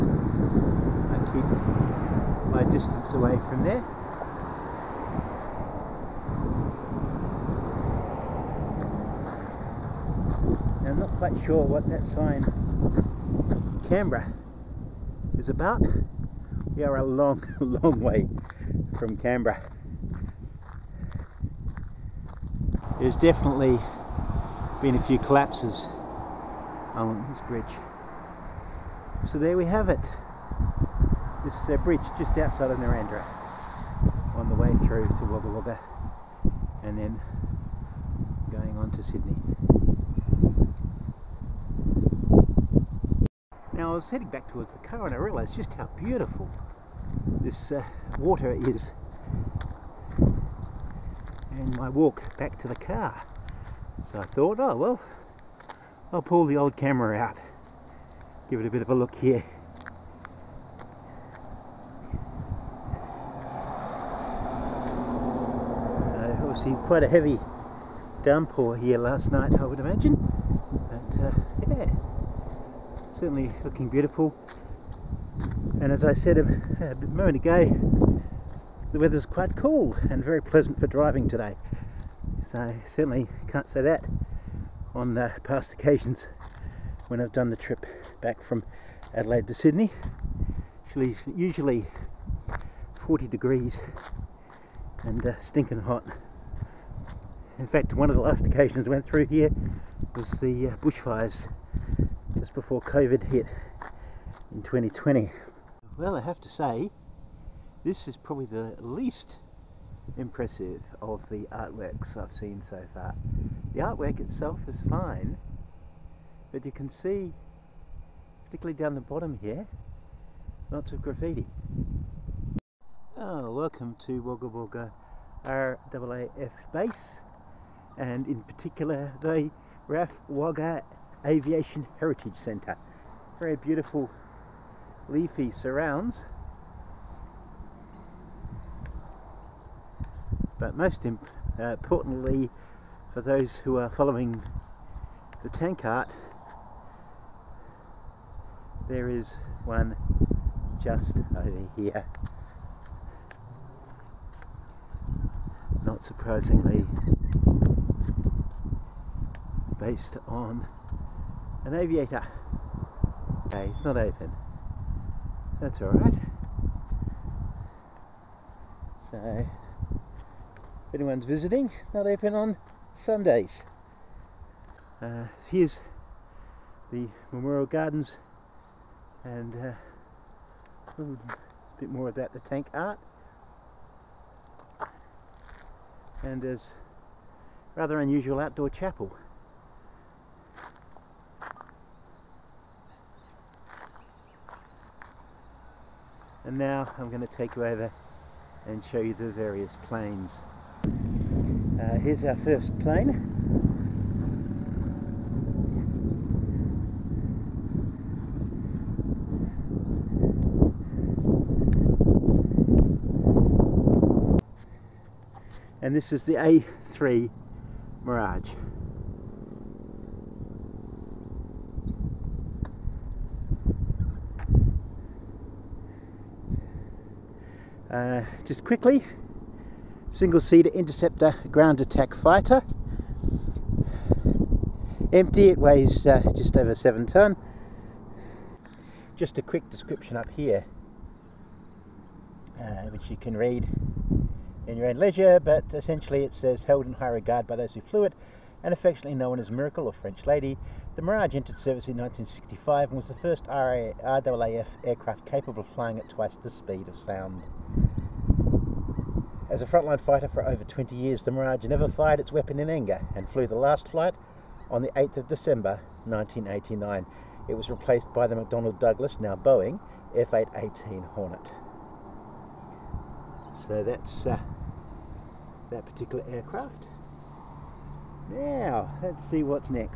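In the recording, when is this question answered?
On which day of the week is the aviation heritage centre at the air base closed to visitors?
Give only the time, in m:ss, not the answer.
2:52.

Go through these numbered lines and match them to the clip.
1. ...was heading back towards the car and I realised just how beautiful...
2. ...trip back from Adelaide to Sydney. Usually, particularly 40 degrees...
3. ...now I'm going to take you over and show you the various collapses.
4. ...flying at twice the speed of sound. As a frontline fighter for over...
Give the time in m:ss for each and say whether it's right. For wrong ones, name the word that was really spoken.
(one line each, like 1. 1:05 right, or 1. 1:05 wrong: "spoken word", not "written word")
1. 0:43 right
2. 1:27 wrong: "usually", not "particularly"
3. 3:16 wrong: "planes", not "collapses"
4. 4:15 right.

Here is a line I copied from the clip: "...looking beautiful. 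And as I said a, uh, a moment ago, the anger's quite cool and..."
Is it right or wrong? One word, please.
wrong.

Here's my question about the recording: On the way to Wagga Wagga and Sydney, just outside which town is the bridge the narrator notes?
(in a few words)
Narrandera.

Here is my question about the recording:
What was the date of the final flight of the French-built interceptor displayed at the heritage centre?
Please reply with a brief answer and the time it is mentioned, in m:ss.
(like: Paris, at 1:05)
8 December 1989, at 4:24.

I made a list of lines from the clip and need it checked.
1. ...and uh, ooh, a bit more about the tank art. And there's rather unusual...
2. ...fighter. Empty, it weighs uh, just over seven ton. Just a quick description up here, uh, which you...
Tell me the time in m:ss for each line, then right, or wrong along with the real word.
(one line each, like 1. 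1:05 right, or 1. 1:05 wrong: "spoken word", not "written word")
1. 2:59 right
2. 3:52 right.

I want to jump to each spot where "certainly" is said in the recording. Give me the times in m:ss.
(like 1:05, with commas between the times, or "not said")
1:13, 1:22.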